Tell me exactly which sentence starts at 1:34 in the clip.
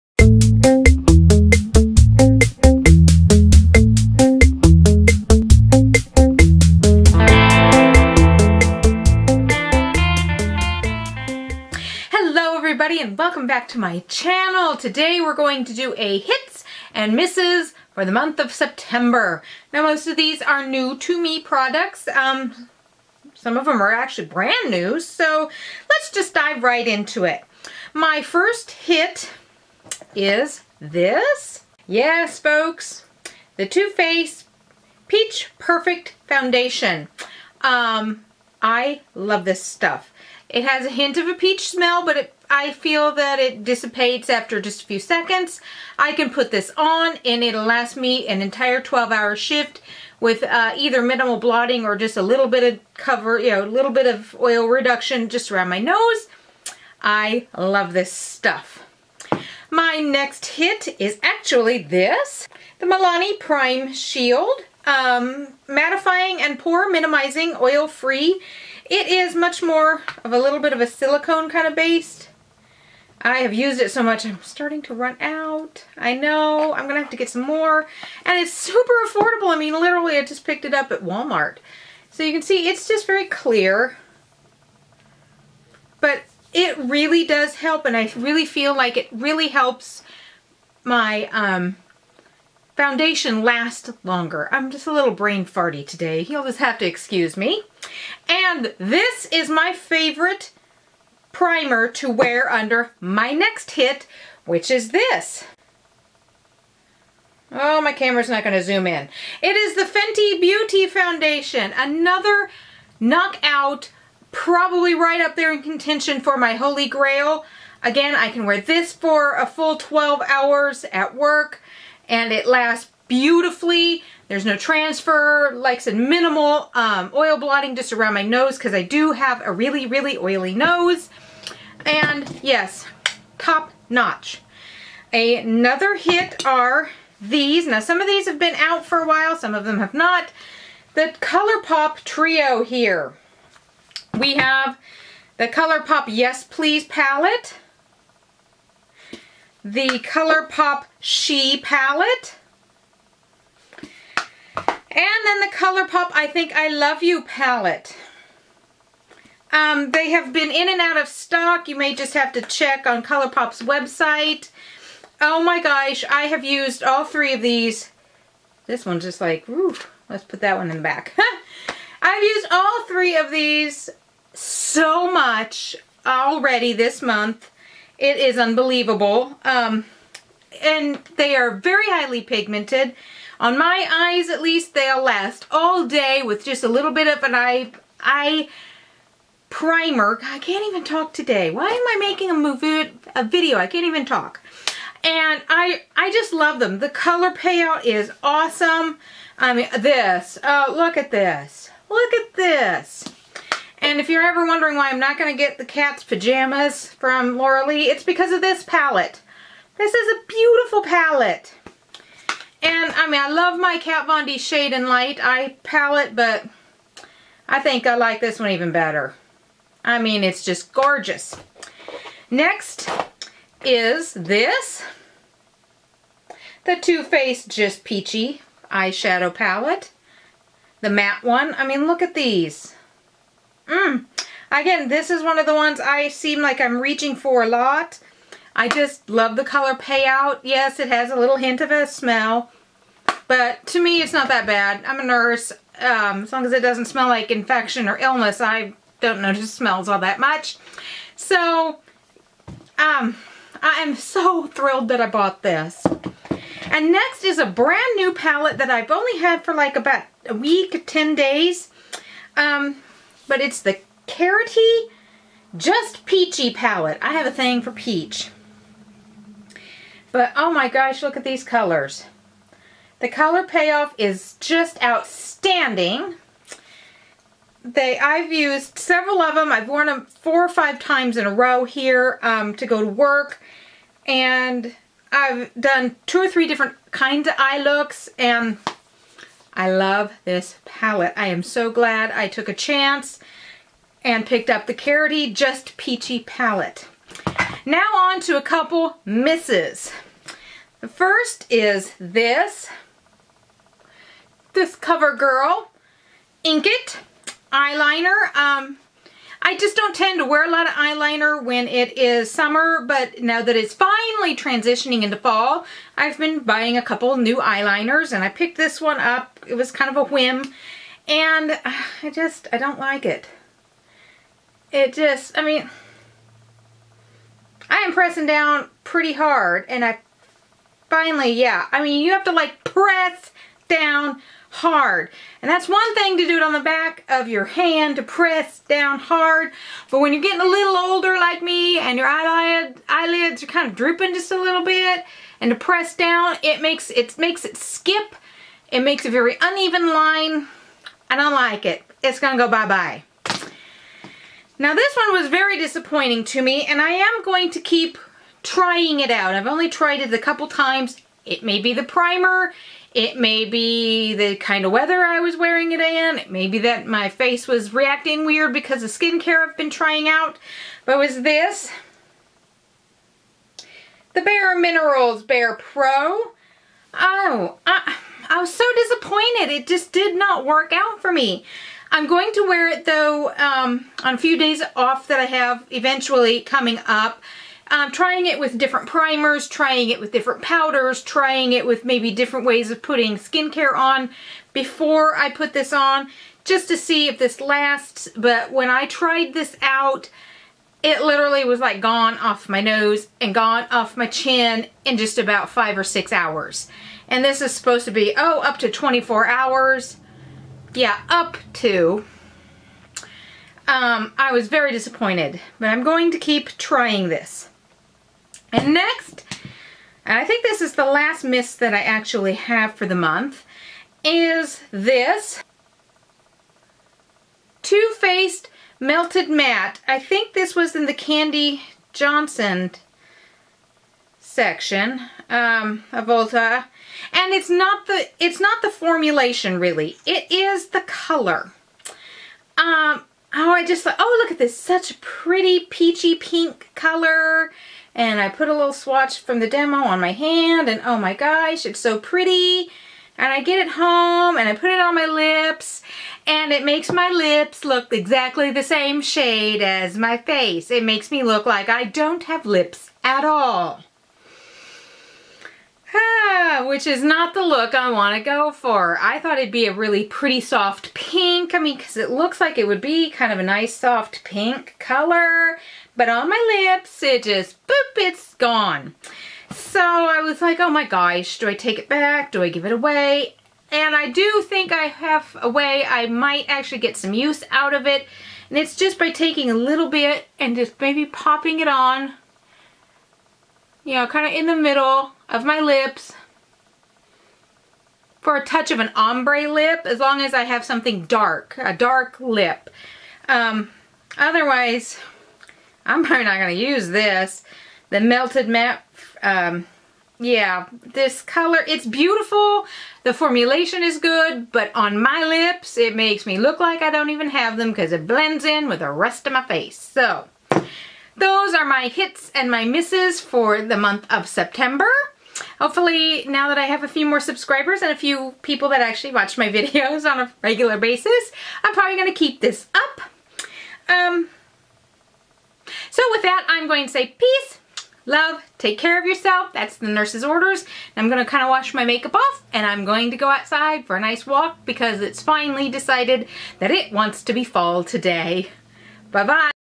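I'm just a little brain farty today.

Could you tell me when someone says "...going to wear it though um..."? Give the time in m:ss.
6:22.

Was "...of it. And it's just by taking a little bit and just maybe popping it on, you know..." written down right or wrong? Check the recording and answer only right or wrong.
right.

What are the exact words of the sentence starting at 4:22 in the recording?
Um, but it's the Carroty Just Peachy palette.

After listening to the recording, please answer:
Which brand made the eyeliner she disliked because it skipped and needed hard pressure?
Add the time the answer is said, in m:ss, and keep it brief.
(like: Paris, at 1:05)
CoverGirl, at 5:04.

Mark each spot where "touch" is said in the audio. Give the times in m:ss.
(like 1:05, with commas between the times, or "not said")
8:18.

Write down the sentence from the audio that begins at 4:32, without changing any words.
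The color payoff is just outstanding they I've used several of them.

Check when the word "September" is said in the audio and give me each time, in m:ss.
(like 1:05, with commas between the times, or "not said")
0:18, 8:44.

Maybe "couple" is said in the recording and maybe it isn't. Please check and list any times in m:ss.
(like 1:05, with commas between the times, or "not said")
4:58, 5:16, 6:00.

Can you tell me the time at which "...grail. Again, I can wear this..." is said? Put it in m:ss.
1:56.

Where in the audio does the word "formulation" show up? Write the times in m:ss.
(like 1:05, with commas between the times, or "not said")
7:18, 8:33.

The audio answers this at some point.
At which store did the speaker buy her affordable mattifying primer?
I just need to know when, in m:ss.
1:21.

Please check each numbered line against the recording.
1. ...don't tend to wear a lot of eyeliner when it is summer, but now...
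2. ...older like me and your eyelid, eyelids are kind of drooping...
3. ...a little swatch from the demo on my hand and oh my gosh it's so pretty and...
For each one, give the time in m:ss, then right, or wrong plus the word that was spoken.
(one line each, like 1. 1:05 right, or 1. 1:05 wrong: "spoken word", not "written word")
1. 5:09 right
2. 5:40 right
3. 7:28 right.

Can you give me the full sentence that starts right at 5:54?
Now this one was very disappointing to me and I am going to keep trying it out.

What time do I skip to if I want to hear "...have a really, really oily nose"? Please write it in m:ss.
2:09.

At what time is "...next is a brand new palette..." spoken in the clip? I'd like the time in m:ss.
4:16.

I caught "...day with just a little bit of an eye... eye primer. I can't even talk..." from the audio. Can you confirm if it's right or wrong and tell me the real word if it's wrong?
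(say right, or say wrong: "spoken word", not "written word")
right.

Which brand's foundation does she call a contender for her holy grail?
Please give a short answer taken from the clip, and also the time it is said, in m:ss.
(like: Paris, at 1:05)
Fenty Beauty, at 1:49.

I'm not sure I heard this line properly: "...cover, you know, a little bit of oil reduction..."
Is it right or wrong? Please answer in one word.
right.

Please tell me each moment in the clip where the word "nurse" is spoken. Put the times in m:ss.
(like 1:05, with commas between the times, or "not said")
4:05, 8:59.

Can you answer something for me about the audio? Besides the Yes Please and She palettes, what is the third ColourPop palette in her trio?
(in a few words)
I Think I Love You.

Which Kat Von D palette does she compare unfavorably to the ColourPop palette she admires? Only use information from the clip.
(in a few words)
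Shade and Light.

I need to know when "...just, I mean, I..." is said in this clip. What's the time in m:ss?
5:24.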